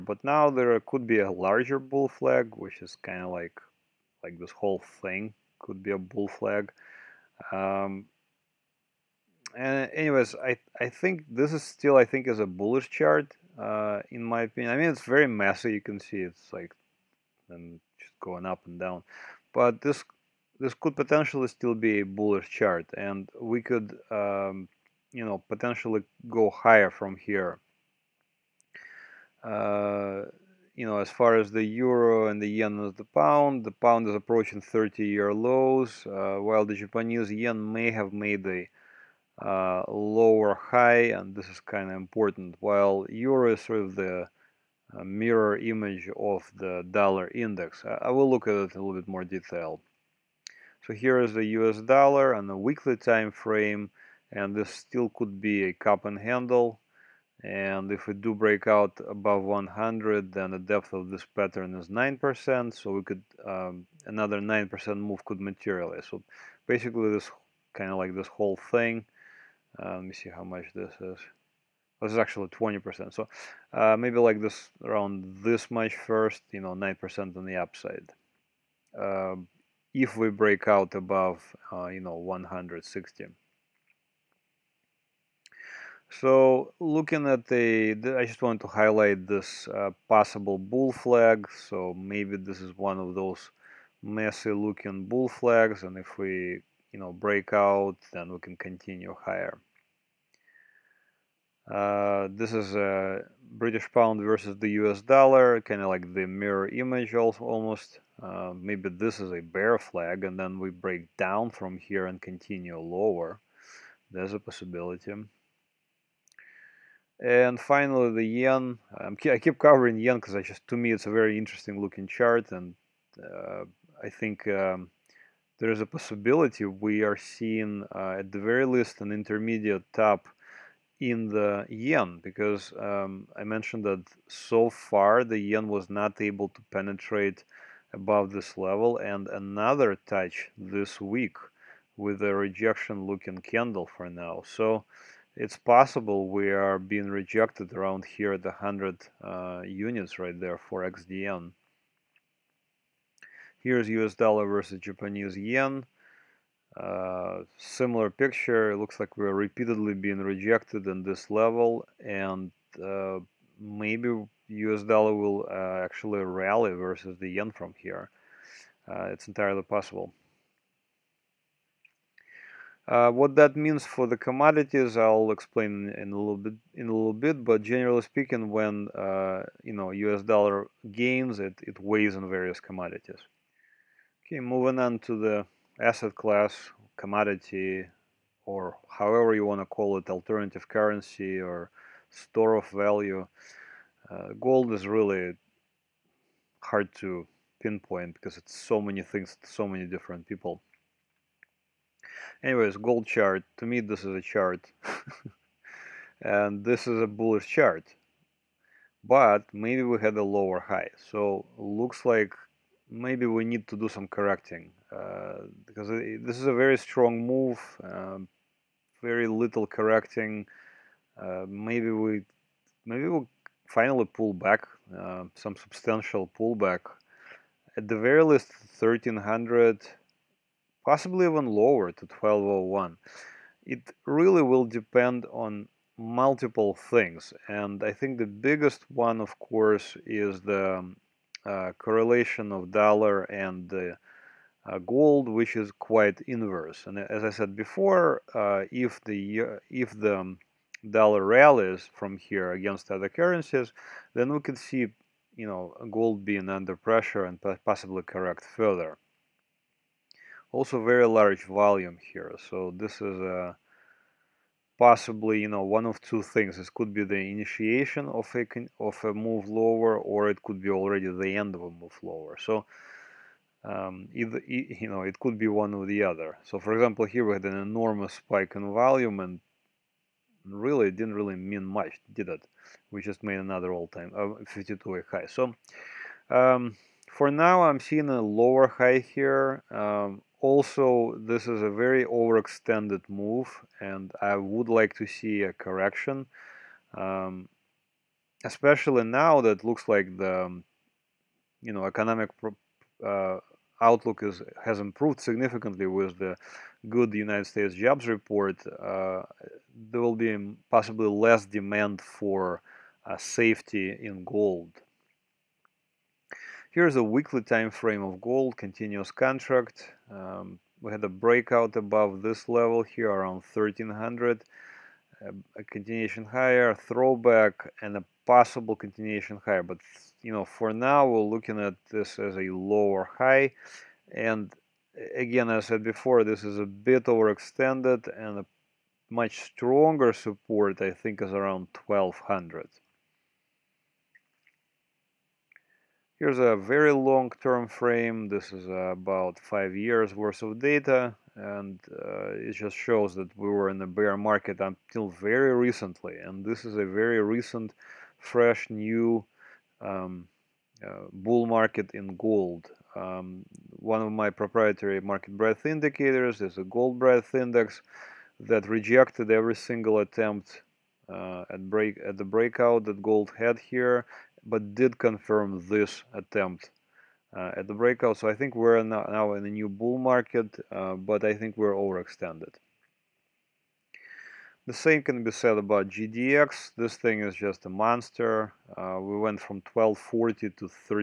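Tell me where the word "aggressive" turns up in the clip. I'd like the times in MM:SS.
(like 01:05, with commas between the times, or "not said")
not said.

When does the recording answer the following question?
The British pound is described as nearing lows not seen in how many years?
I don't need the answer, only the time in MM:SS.
00:34.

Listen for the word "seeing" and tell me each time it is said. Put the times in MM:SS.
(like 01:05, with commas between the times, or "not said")
02:07, 04:47.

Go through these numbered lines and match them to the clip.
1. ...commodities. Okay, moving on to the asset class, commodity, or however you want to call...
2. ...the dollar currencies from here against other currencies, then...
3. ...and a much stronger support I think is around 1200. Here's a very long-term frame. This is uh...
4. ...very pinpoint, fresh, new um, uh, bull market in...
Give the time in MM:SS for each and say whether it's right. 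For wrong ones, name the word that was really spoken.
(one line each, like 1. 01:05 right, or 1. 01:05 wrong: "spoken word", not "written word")
1. 03:02 right
2. 04:09 wrong: "rallies", not "currencies"
3. 05:38 right
4. 05:56 wrong: "recent", not "pinpoint".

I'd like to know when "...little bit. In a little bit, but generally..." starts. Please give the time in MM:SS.
02:56.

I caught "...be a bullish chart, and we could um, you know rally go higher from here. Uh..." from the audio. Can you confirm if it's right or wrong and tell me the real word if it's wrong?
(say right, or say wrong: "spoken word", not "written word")
wrong: "potentially", not "rally".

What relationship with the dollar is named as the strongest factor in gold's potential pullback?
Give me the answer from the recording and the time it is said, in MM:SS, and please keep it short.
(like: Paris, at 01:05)
correlation, at 04:01.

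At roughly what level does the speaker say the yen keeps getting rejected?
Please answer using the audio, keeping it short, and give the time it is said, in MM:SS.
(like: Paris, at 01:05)
100, at 02:28.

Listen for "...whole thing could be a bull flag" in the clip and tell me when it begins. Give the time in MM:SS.
00:04.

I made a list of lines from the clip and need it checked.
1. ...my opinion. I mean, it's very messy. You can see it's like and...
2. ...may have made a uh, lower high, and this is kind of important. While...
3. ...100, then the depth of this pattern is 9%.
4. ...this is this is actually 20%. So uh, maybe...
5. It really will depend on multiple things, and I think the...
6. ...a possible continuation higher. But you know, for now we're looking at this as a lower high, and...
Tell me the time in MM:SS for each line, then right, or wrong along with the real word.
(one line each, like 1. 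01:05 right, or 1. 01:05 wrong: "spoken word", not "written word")
1. 00:14 right
2. 00:37 right
3. 00:59 right
4. 01:10 right
5. 03:53 right
6. 05:27 right.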